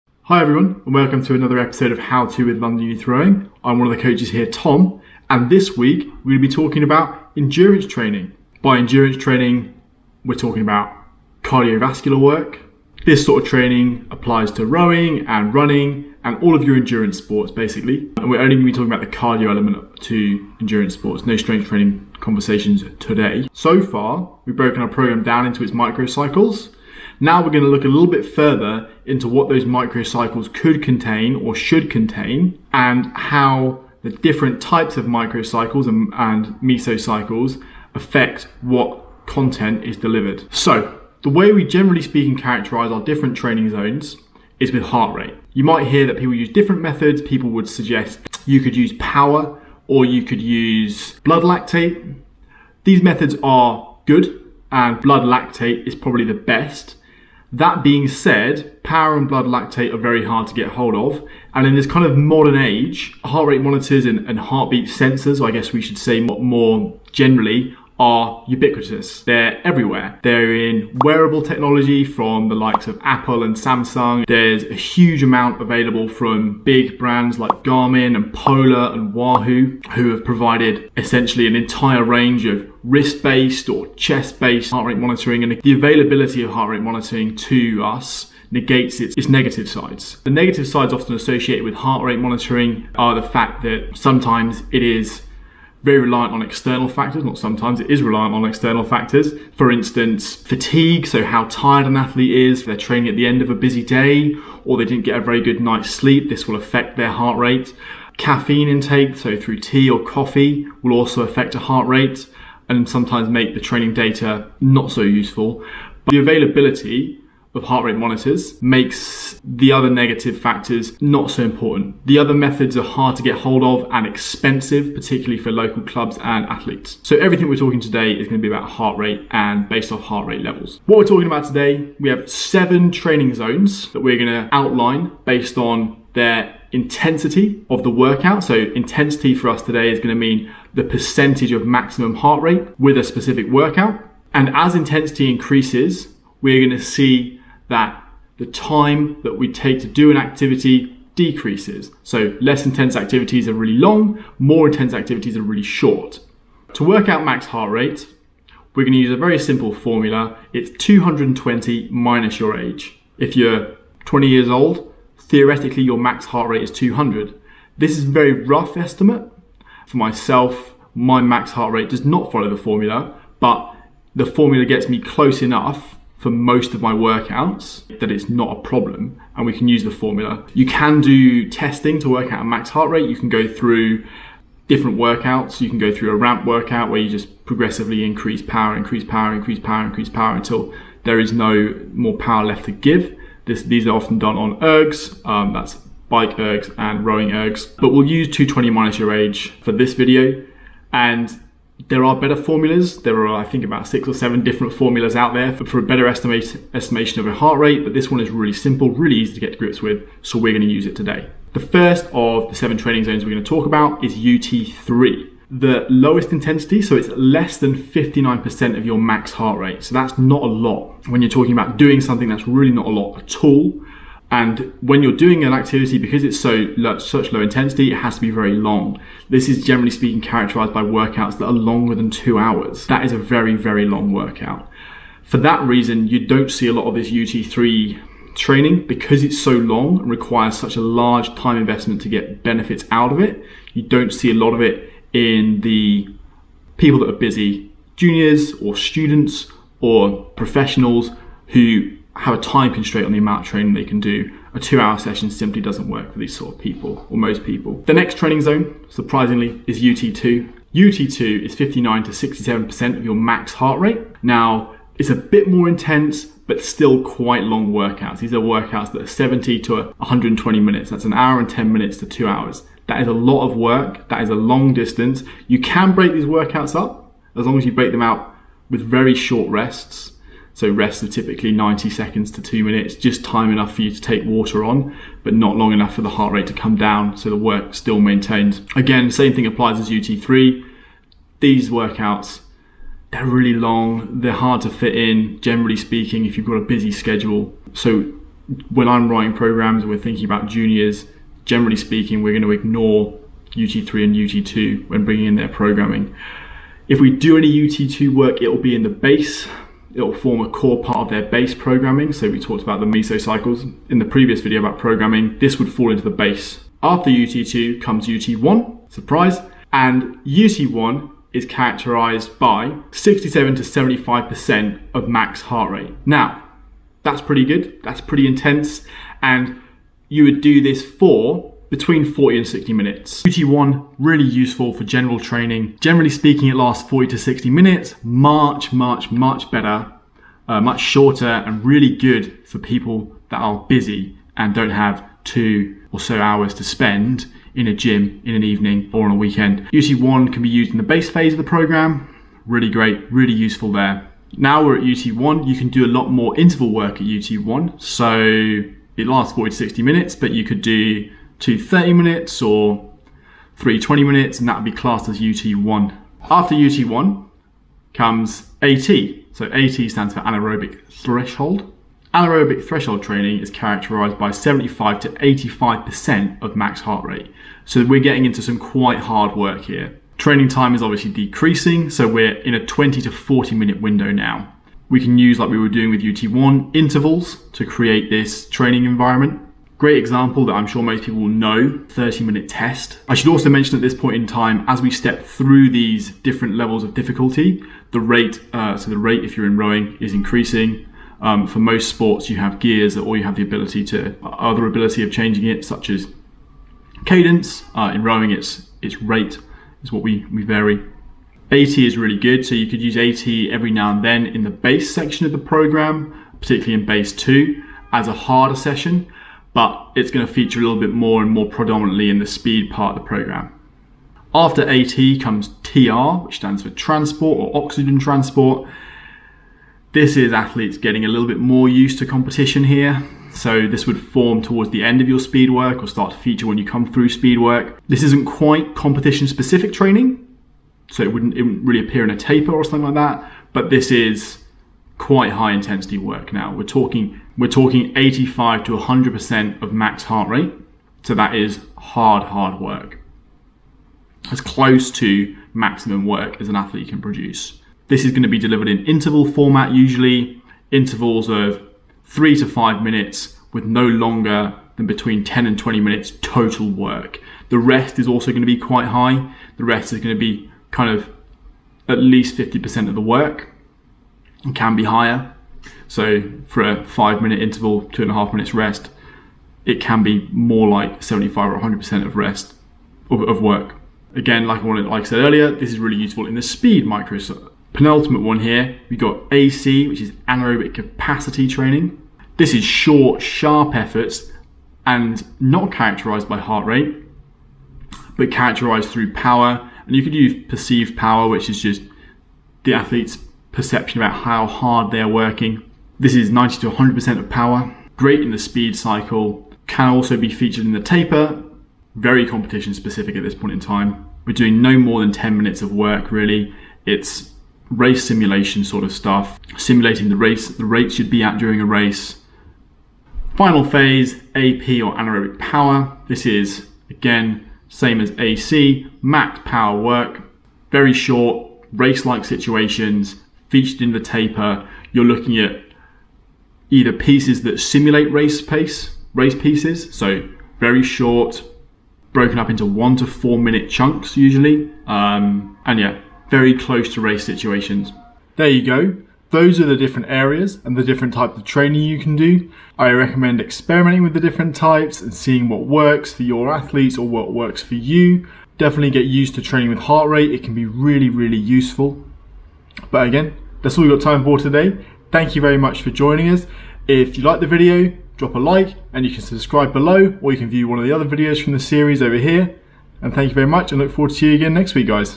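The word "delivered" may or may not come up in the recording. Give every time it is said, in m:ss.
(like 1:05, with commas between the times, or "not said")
0:39, 7:38.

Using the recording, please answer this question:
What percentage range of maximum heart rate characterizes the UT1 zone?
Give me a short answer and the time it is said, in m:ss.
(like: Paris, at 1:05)
67 to 75%, at 5:22.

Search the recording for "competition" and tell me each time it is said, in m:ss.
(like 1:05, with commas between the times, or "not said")
7:12, 7:18, 8:32.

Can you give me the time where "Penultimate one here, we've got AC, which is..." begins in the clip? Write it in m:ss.
8:07.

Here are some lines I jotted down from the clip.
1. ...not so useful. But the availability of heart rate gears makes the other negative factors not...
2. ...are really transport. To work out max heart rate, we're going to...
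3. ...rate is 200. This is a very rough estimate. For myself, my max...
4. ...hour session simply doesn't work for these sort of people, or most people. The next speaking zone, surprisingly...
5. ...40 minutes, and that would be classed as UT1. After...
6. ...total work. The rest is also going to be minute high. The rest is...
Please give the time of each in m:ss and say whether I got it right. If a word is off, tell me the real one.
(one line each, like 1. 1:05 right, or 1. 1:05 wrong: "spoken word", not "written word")
1. 1:54 wrong: "monitors", not "gears"
2. 2:35 wrong: "short", not "transport"
3. 2:46 right
4. 4:14 wrong: "training", not "speaking"
5. 6:03 wrong: "20", not "40"
6. 7:46 wrong: "quite", not "minute".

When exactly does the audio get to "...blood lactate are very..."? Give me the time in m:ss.
0:59.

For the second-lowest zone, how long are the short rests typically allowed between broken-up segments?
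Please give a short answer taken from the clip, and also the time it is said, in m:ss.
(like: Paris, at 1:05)
90 seconds to 2 minutes, at 4:41.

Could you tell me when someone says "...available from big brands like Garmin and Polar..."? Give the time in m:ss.
1:15.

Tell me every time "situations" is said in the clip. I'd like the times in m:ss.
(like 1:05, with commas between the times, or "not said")
8:52, 9:07.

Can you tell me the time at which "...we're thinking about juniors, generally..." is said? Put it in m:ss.
4:59.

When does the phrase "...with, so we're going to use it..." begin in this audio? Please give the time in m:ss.
3:29.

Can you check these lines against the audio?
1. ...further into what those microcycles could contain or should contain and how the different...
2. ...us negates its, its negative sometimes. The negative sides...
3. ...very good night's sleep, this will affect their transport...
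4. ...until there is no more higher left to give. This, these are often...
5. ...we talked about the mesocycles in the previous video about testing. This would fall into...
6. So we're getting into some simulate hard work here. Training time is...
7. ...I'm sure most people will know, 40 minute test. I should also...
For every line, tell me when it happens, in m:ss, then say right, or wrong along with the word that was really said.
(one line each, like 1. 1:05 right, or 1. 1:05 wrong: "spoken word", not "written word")
1. 0:28 right
2. 1:27 wrong: "sides", not "sometimes"
3. 1:45 wrong: "heart", not "transport"
4. 3:10 wrong: "power", not "higher"
5. 5:12 wrong: "programming", not "testing"
6. 6:17 wrong: "quite", not "simulate"
7. 6:30 wrong: "30", not "40".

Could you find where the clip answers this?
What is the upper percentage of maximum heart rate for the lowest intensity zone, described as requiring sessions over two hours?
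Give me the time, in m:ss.
3:37.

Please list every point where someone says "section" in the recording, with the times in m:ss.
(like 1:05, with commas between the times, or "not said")
6:54.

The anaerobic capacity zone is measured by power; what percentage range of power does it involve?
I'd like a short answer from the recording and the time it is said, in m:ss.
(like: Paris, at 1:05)
90 to 100%, at 8:26.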